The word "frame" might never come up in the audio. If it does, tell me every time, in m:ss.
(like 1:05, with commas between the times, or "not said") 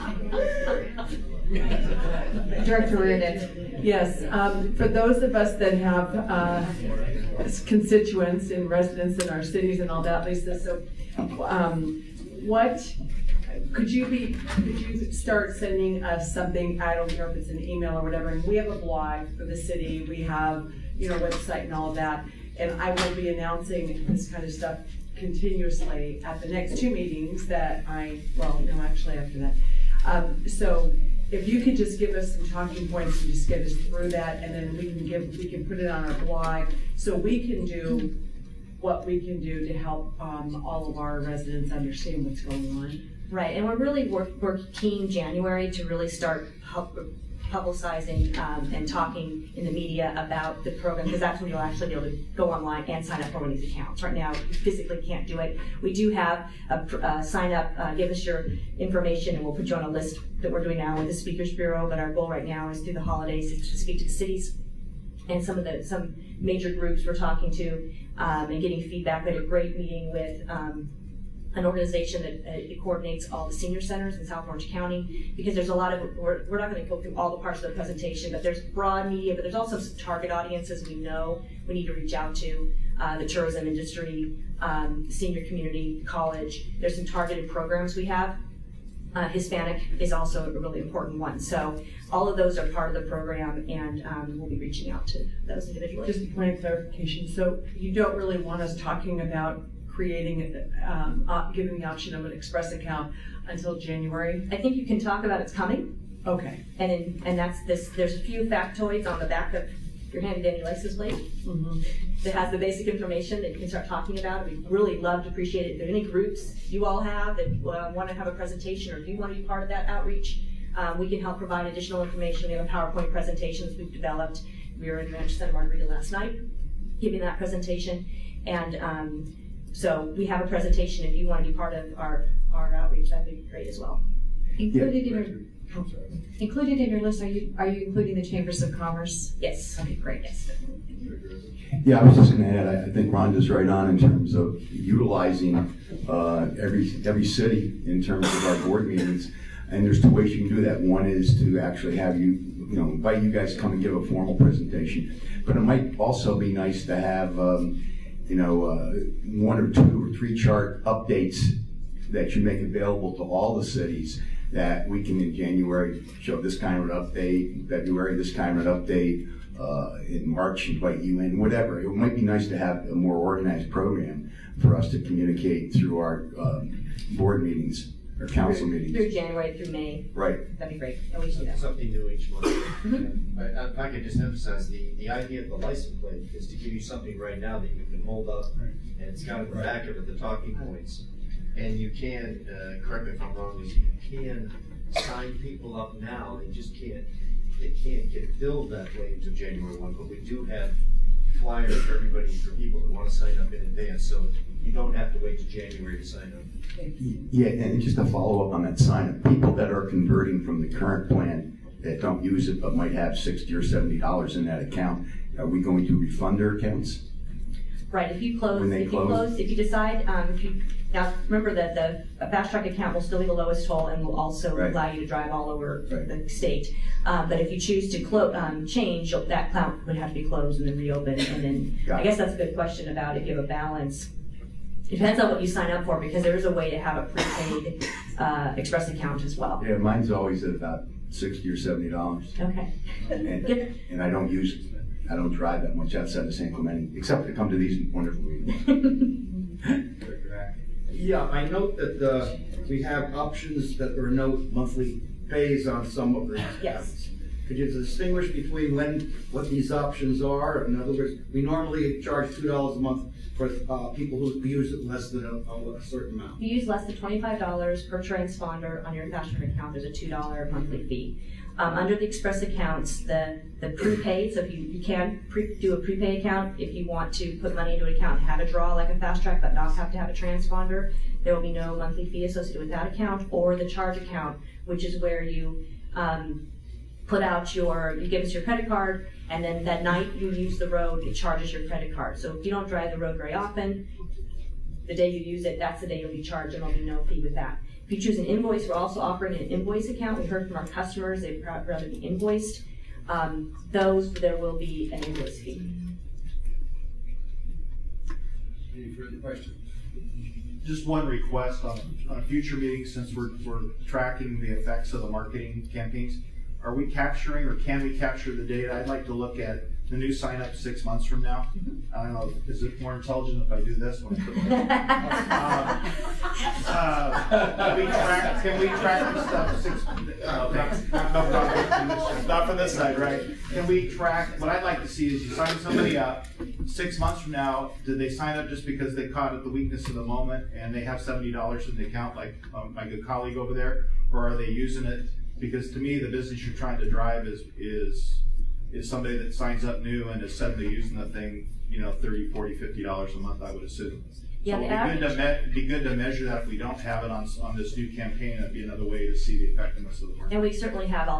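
not said.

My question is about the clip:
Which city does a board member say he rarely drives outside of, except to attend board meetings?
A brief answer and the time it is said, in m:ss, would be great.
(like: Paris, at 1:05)
San Clemente, at 4:06.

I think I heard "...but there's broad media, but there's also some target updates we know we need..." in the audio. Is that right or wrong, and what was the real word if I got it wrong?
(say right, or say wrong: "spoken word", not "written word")
wrong: "audiences", not "updates".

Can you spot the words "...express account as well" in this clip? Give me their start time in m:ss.
3:58.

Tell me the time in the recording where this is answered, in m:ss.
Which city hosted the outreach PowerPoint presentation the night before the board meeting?
2:05.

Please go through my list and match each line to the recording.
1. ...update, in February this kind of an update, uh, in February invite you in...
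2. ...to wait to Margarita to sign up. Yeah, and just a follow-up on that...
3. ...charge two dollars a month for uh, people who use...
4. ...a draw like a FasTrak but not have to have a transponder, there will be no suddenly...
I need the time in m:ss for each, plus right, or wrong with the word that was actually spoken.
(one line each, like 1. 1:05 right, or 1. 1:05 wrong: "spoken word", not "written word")
1. 2:46 wrong: "March", not "February"
2. 3:25 wrong: "January", not "Margarita"
3. 4:22 right
4. 4:38 wrong: "monthly", not "suddenly".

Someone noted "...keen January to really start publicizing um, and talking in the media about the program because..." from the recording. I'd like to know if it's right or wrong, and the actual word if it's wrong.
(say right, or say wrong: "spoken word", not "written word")
right.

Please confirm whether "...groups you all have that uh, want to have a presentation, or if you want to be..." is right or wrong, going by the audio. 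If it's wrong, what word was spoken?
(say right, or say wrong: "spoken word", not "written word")
right.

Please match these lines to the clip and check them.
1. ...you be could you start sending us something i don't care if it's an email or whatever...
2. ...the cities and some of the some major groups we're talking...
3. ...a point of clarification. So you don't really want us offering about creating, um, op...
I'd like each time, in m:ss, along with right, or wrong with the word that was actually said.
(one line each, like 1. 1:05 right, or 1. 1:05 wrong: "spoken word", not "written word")
1. 0:13 right
2. 1:04 right
3. 1:36 wrong: "talking", not "offering".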